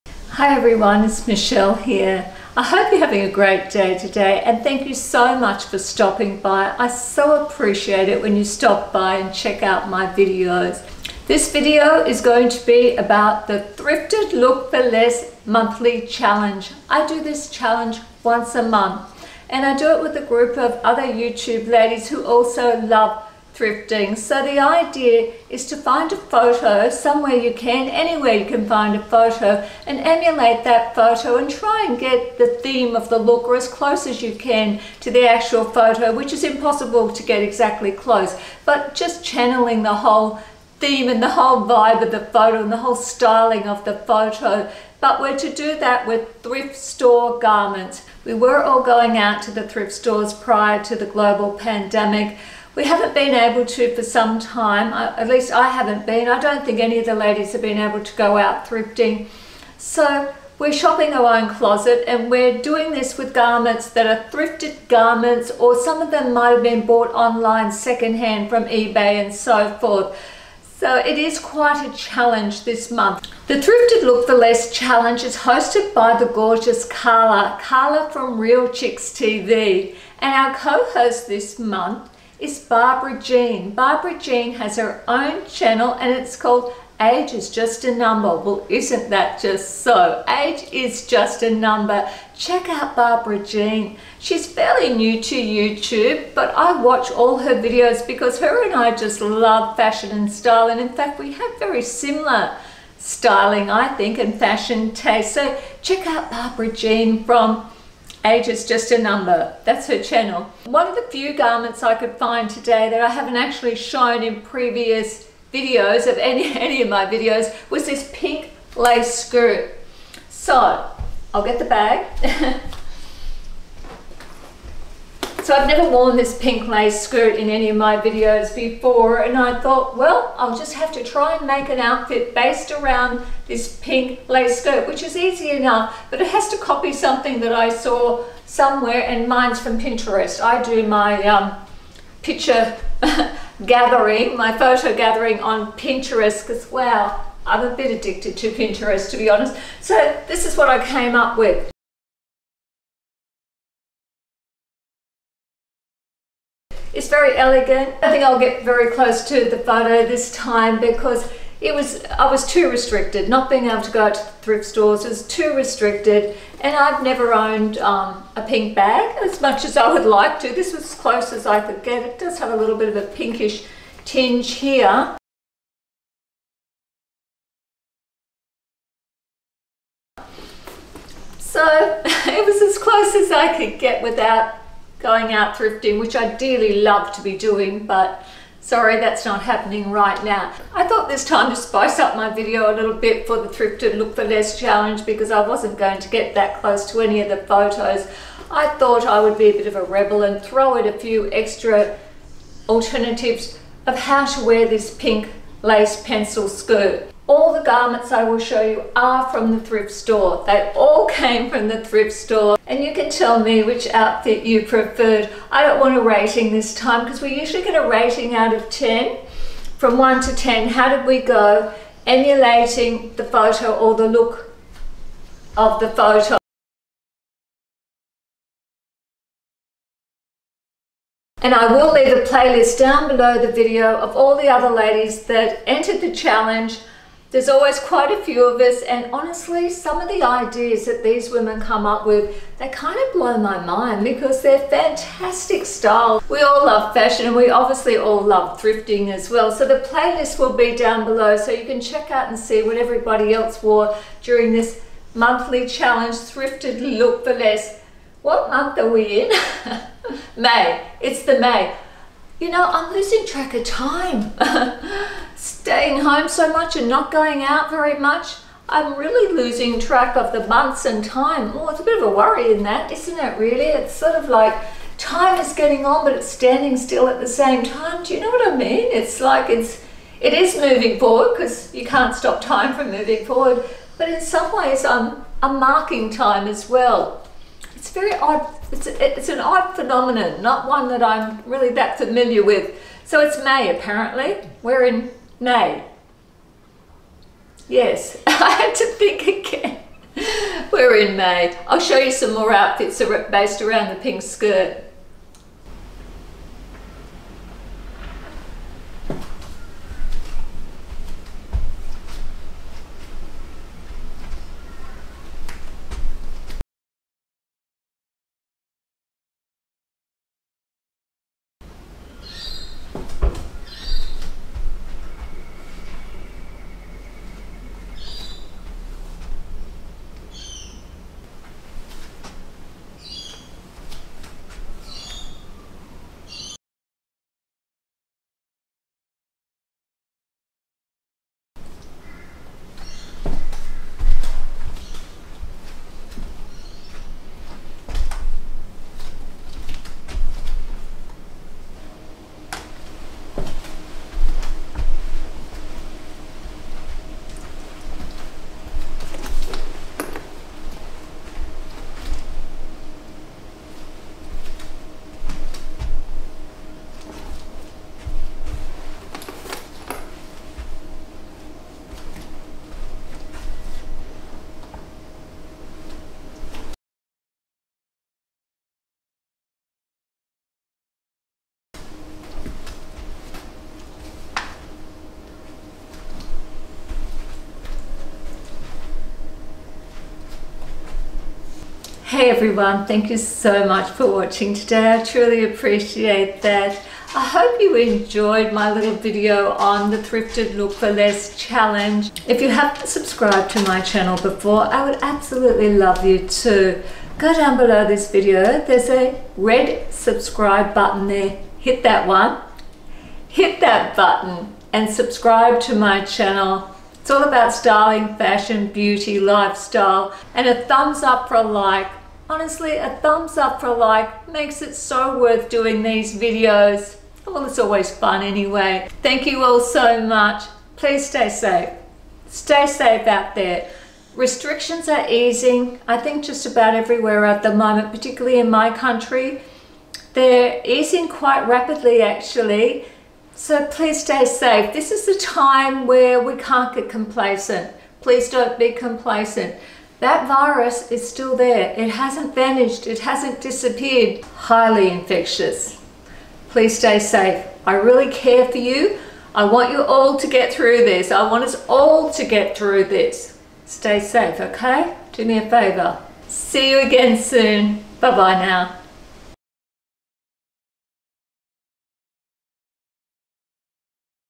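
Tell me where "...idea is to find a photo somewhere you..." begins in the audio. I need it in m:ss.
0:24.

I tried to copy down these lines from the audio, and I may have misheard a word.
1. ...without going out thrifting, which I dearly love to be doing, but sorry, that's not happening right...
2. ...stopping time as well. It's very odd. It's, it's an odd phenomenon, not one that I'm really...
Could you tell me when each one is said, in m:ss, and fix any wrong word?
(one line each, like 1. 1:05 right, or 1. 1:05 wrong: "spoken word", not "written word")
1. 3:04 right
2. 4:45 wrong: "marking", not "stopping".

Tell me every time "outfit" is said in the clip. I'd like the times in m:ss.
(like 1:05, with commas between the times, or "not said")
2:11, 3:33, 5:02.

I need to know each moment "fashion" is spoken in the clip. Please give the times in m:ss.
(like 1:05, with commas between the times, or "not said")
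1:39, 1:44, 4:06, 6:58.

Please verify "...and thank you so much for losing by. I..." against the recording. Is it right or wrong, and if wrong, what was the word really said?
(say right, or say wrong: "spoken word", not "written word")
wrong: "stopping", not "losing".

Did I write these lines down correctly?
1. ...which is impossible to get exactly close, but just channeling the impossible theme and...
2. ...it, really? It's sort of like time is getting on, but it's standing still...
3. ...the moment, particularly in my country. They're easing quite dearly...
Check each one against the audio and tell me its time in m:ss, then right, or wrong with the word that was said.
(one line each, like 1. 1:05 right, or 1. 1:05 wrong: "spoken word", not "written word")
1. 0:36 wrong: "whole", not "impossible"
2. 4:33 right
3. 7:17 wrong: "rapidly", not "dearly".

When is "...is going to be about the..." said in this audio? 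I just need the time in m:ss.
0:12.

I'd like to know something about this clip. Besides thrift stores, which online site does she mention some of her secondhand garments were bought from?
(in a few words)
eBay.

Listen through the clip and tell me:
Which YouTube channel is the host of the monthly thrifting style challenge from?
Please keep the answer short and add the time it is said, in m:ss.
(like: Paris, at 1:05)
Real Chicks TV, at 1:18.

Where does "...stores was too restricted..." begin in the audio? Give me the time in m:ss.
2:44.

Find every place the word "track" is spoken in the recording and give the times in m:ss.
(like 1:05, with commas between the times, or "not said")
4:23, 4:29.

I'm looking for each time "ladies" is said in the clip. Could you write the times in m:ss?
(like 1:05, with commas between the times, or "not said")
0:21, 0:57, 3:54.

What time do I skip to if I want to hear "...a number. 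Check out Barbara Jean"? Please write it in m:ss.
1:31.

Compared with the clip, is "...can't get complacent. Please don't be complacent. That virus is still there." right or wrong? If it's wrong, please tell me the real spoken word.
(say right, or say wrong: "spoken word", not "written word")
right.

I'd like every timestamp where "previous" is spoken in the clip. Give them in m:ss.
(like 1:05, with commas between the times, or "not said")
1:54.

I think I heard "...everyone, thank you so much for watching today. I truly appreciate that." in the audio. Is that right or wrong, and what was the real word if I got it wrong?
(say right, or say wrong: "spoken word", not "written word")
right.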